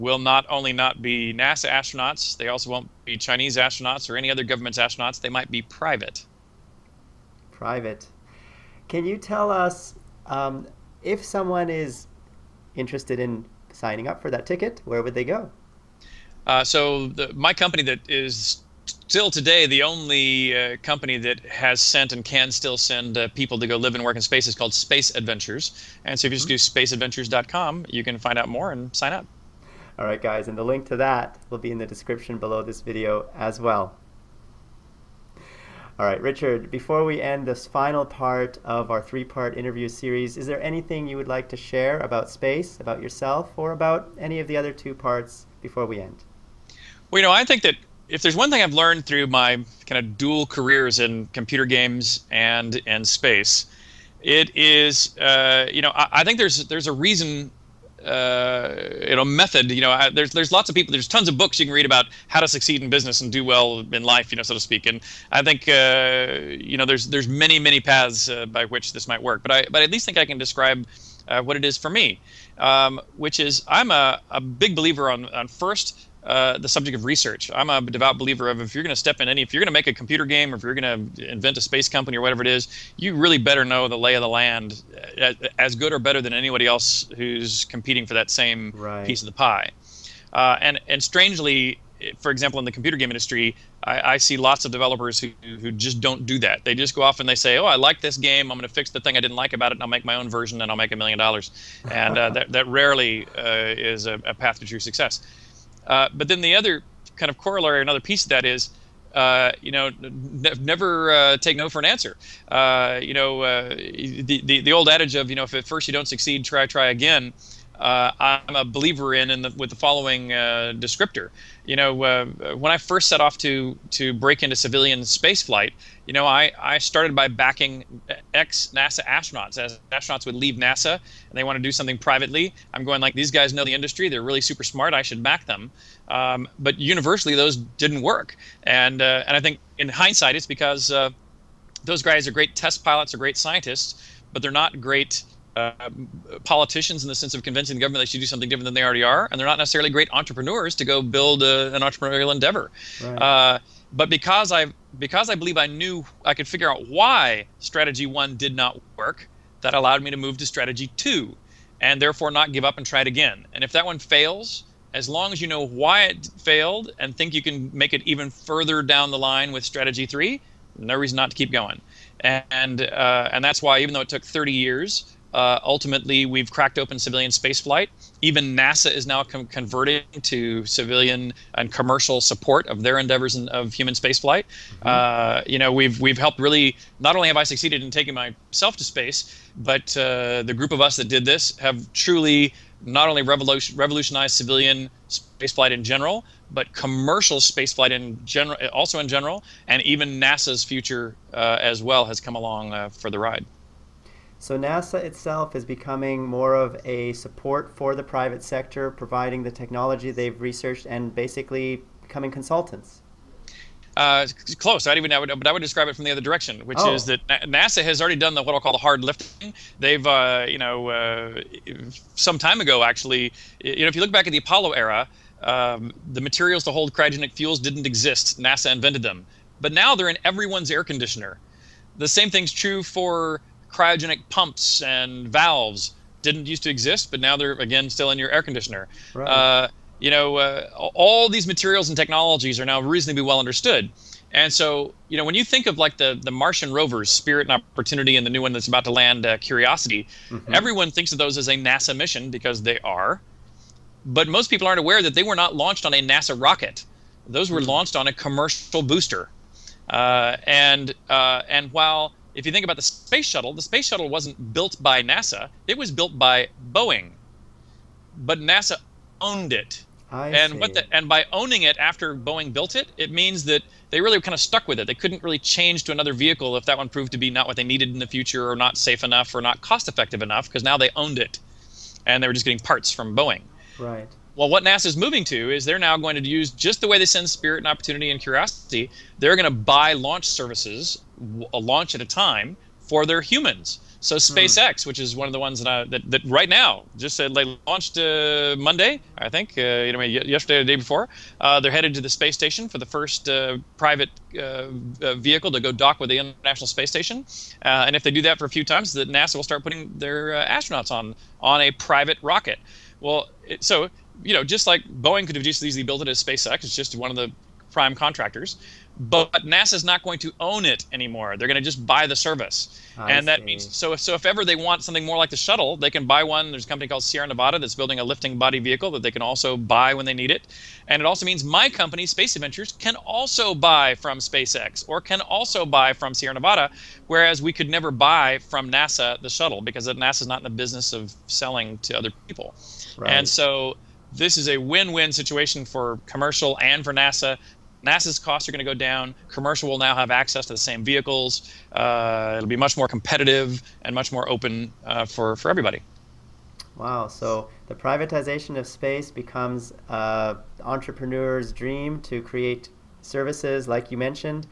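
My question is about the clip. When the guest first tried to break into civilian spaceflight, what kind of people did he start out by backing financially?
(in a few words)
ex NASA astronauts.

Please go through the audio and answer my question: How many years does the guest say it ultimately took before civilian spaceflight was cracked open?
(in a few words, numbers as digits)
30.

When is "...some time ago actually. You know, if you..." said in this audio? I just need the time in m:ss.
3:42.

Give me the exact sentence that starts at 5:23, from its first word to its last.
If, so if ever they want something more like the shuttle, they can buy one.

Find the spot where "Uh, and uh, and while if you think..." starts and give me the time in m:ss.
4:19.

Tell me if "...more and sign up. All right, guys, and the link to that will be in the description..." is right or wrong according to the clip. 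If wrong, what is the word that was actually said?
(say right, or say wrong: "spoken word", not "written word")
right.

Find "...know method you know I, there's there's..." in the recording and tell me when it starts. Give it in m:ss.
0:59.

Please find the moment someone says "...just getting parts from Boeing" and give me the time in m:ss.
4:42.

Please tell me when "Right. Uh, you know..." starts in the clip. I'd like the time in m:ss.
3:59.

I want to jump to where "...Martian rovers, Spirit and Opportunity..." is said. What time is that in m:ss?
4:06.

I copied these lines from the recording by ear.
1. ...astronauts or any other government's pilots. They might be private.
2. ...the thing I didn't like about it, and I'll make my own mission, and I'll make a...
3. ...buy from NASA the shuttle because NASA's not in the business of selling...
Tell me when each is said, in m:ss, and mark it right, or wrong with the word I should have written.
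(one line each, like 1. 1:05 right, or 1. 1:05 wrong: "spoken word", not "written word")
1. 0:03 wrong: "astronauts", not "pilots"
2. 1:38 wrong: "version", not "mission"
3. 5:37 right.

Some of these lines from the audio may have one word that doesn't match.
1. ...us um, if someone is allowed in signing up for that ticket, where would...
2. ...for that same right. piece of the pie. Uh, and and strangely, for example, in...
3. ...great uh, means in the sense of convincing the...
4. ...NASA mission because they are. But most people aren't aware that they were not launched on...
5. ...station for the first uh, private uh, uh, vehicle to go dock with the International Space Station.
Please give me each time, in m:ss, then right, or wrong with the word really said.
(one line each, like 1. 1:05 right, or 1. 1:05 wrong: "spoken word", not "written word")
1. 0:09 wrong: "interested", not "allowed"
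2. 1:28 right
3. 2:24 wrong: "politicians", not "means"
4. 4:11 right
5. 5:02 right.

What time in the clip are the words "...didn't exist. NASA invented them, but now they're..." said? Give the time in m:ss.
3:47.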